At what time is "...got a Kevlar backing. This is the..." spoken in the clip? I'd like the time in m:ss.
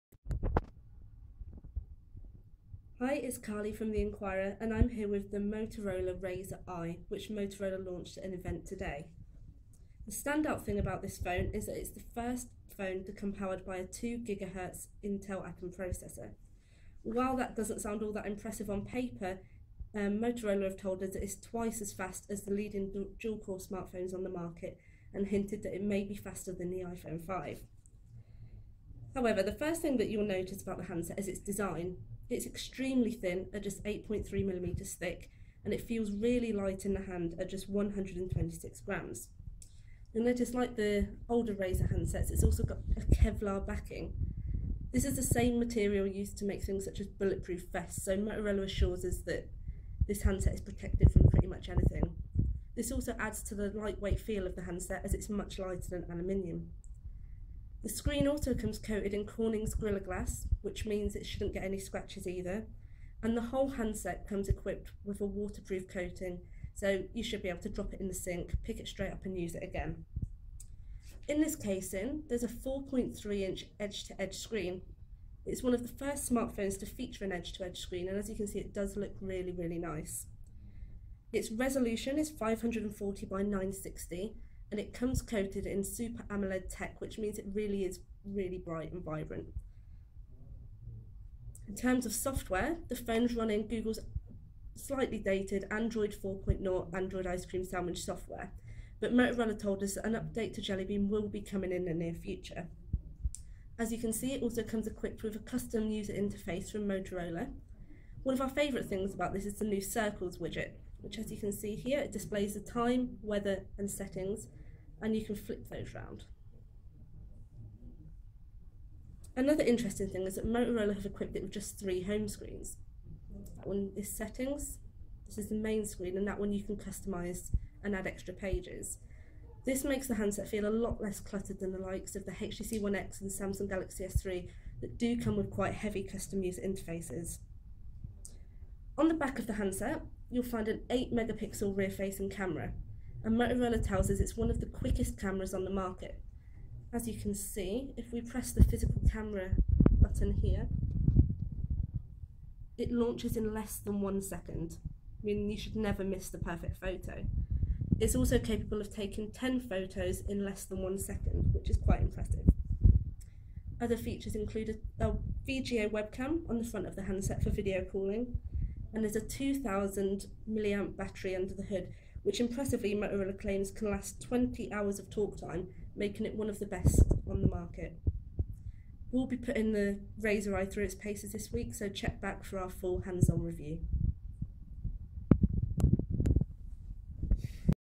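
0:42.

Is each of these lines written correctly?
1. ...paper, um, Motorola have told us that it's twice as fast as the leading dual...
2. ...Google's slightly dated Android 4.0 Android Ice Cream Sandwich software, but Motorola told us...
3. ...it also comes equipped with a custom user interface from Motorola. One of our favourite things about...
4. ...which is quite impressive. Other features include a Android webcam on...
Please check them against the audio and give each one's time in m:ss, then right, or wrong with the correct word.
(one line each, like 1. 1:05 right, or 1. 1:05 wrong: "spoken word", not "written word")
1. 0:18 right
2. 1:33 right
3. 1:44 right
4. 2:41 wrong: "VGA", not "Android".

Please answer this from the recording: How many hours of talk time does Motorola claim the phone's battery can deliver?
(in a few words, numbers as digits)
20 hours.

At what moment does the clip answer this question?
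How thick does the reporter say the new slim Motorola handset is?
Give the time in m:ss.
0:33.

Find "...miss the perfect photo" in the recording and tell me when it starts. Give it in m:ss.
2:36.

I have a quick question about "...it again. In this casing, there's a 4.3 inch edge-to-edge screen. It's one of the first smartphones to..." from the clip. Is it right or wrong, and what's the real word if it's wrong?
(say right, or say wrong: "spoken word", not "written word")
right.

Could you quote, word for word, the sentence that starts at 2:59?
We'll be putting the Razr i through its paces this week, so check back for our full hands-on review.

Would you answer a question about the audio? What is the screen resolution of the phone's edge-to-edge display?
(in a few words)
540 by 960.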